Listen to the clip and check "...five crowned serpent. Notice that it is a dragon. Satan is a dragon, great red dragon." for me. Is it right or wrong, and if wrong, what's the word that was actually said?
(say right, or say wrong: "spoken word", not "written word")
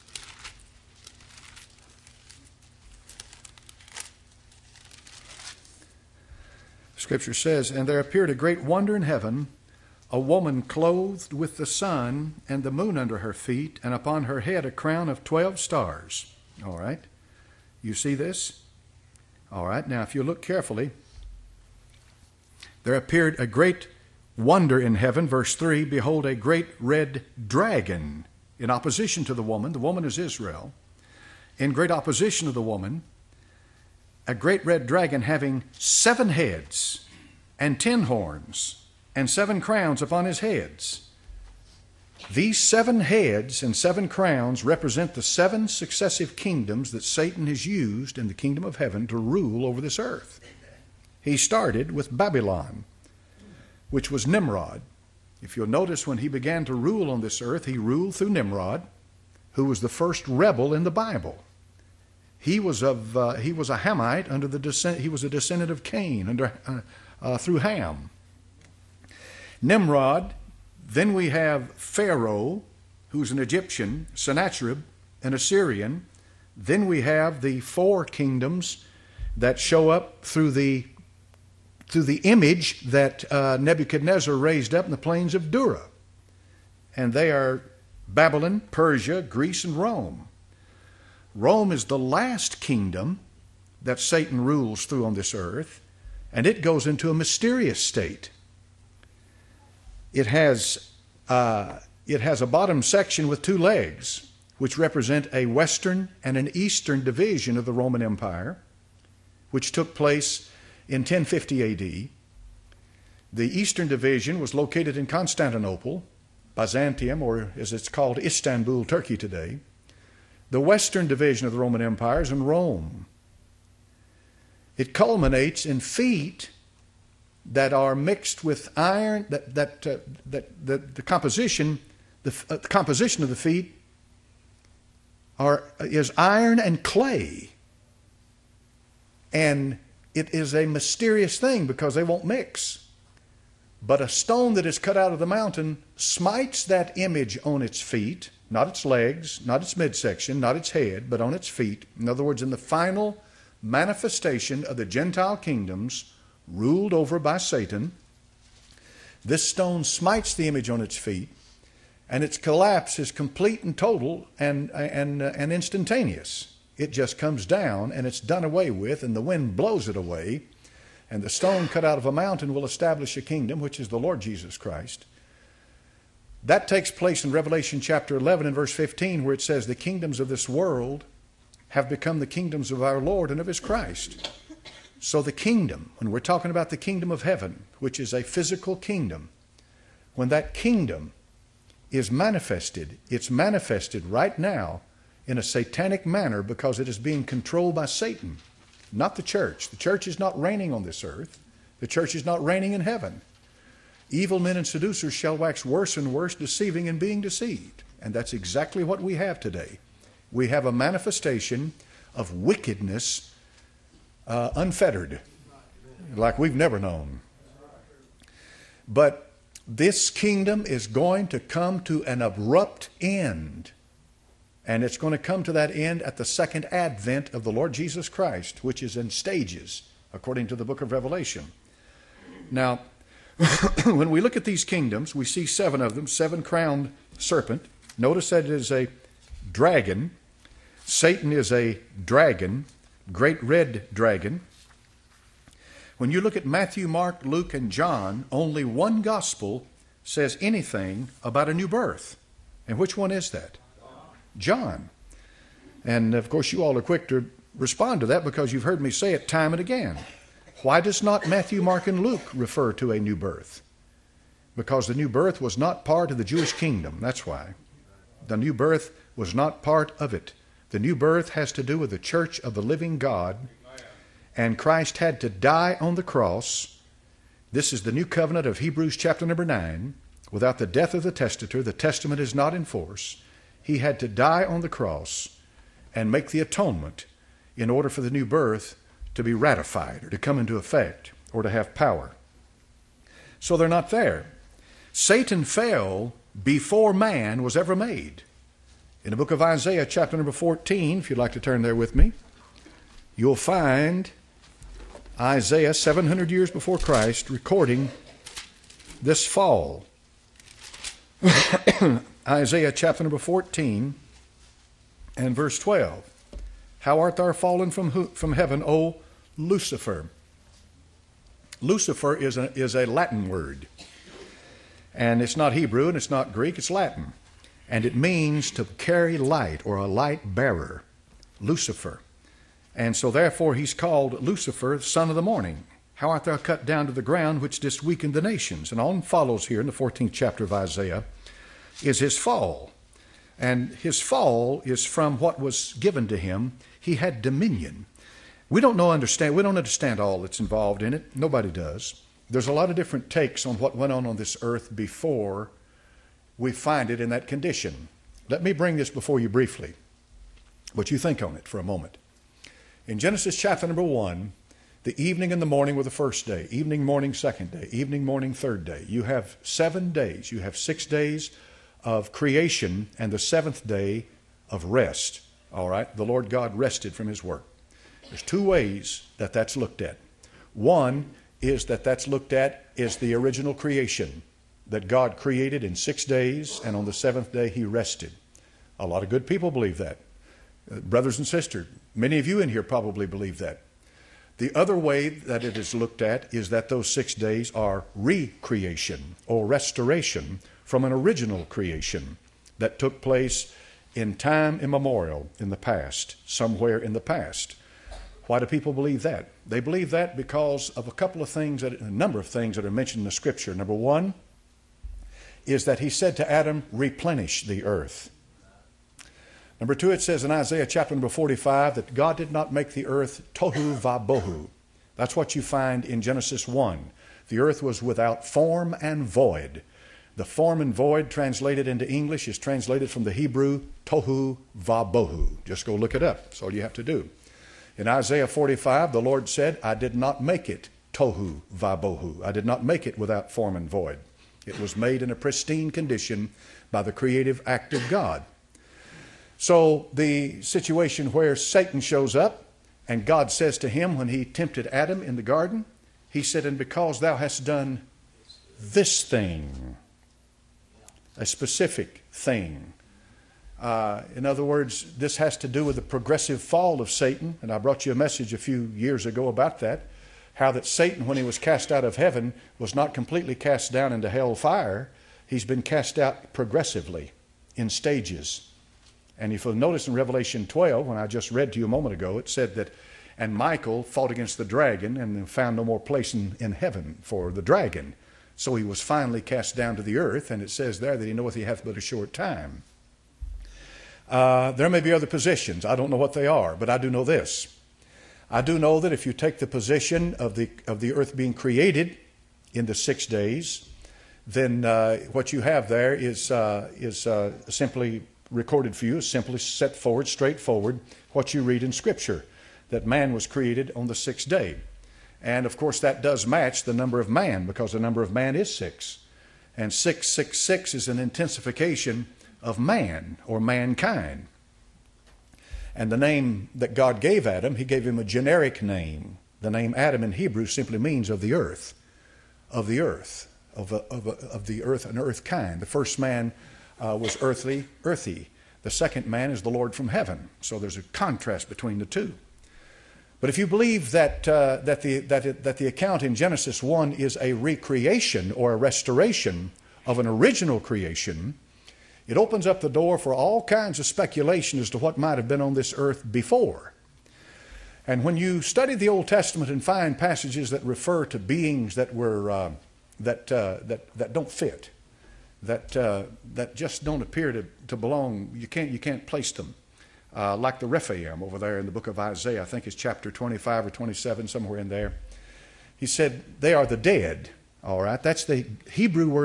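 wrong: "seven", not "five".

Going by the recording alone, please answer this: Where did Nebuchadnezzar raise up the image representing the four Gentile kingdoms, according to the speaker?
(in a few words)
plains of Dura.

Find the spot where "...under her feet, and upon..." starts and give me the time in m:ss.
0:12.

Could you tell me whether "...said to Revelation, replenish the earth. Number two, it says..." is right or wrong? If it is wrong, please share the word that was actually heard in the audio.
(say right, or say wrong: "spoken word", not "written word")
wrong: "Adam", not "Revelation".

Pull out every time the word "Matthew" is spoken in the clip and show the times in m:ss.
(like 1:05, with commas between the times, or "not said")
4:06, 4:21.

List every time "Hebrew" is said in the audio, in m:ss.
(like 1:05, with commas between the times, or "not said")
4:38, 5:25, 7:13, 8:50, 9:38.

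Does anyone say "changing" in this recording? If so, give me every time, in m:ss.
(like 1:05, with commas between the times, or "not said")
not said.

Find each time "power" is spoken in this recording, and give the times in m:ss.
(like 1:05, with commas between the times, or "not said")
4:51.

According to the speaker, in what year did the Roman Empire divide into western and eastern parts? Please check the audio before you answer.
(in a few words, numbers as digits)
1050 AD.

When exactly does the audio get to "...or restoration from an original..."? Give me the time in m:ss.
6:39.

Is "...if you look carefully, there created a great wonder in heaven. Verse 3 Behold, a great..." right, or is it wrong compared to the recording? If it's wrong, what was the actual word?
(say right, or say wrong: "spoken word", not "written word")
wrong: "appeared", not "created".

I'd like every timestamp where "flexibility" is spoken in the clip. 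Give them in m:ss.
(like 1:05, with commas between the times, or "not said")
not said.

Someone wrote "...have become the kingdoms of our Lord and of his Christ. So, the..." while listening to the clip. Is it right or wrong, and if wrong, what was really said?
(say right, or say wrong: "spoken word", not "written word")
right.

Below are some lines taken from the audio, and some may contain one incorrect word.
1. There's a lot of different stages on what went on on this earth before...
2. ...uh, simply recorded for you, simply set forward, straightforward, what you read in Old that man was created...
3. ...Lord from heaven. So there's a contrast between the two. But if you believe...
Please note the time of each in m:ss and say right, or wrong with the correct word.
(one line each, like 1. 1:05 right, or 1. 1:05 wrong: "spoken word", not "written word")
1. 5:52 wrong: "takes", not "stages"
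2. 8:27 wrong: "Scripture", not "Old"
3. 8:59 right.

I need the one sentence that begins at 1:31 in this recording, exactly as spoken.
Rome is the last kingdom that Satan rules through on this earth, and it goes into a mysterious state.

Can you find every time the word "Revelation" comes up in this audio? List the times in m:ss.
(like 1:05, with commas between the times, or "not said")
2:57, 3:50, 7:59.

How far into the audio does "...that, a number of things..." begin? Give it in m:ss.
6:51.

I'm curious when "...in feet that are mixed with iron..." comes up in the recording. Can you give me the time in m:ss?
2:05.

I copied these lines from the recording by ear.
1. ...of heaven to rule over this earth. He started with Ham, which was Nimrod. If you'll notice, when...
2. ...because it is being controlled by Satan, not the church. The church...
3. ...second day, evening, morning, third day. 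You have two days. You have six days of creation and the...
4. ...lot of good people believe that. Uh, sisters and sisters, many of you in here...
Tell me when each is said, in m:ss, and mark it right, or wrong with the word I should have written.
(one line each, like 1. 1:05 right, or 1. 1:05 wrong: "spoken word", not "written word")
1. 0:48 wrong: "Babylon", not "Ham"
2. 3:16 right
3. 6:07 wrong: "seven", not "two"
4. 6:28 wrong: "brothers", not "sisters".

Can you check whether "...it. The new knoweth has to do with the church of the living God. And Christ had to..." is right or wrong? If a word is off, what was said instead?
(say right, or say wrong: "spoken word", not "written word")
wrong: "birth", not "knoweth".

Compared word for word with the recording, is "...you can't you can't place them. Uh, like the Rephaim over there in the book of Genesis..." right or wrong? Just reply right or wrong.
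wrong.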